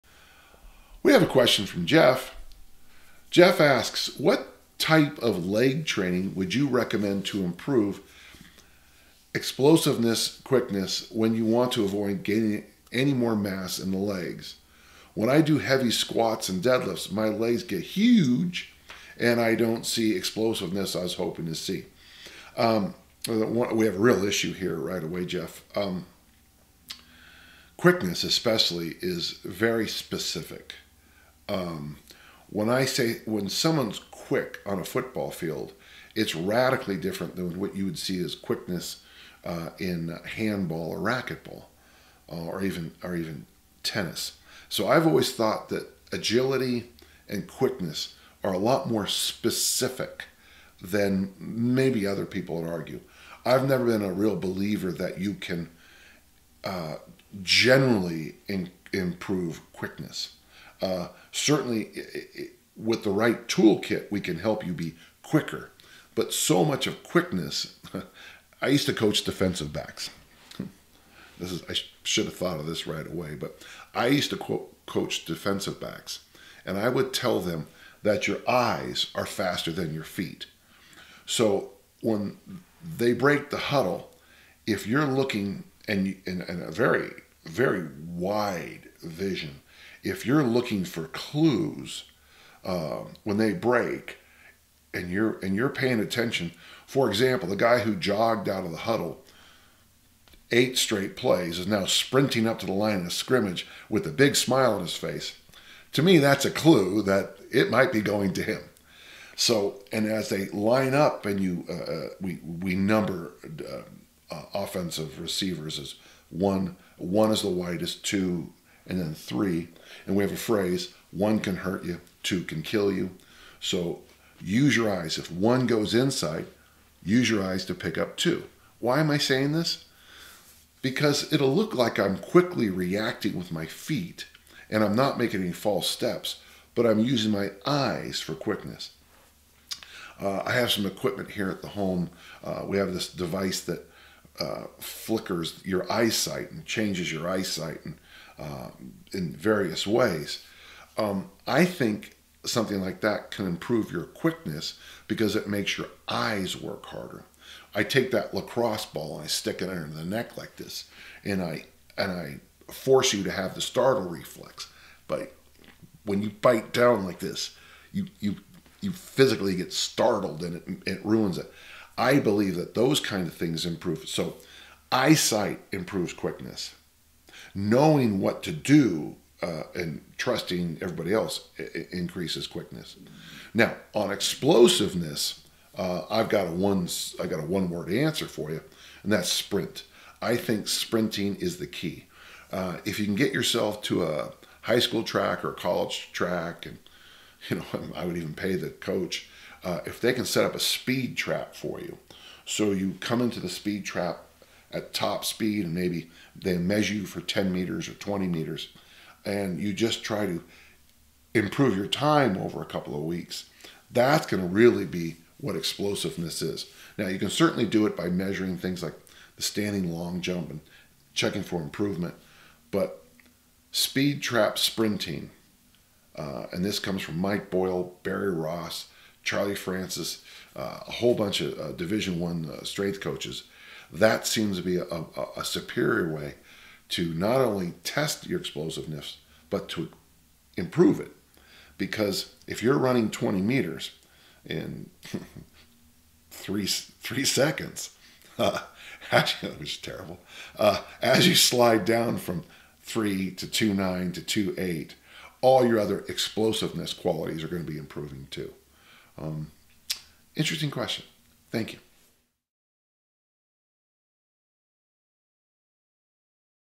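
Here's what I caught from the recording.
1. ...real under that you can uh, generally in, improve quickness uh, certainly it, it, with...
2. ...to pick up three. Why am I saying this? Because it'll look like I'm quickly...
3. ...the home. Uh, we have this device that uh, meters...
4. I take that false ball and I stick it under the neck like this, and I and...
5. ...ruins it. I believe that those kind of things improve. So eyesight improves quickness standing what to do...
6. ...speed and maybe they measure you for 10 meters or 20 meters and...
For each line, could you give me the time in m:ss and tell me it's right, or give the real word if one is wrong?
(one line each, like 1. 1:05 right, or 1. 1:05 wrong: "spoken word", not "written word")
1. 0:54 wrong: "believer", not "under"
2. 2:07 wrong: "two", not "three"
3. 2:21 wrong: "flickers", not "meters"
4. 2:37 wrong: "lacrosse", not "false"
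5. 2:51 wrong: "knowing", not "standing"
6. 3:25 right.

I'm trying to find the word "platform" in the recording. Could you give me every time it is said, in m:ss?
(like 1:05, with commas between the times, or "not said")
not said.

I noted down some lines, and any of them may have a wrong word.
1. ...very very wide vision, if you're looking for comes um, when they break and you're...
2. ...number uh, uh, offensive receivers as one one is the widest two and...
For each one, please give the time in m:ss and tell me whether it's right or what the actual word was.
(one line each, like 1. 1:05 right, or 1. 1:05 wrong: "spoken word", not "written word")
1. 1:26 wrong: "clues", not "comes"
2. 1:52 right.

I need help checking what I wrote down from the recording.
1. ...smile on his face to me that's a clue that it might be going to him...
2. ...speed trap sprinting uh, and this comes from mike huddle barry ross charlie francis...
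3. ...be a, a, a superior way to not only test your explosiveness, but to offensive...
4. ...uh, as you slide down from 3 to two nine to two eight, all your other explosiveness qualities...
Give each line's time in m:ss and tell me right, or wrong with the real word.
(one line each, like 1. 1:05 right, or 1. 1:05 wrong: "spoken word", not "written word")
1. 1:44 right
2. 3:43 wrong: "boyle", not "huddle"
3. 3:54 wrong: "improve", not "offensive"
4. 4:10 right.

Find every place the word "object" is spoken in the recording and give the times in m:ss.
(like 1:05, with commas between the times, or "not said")
not said.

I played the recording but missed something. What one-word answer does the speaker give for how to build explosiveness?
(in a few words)
sprint.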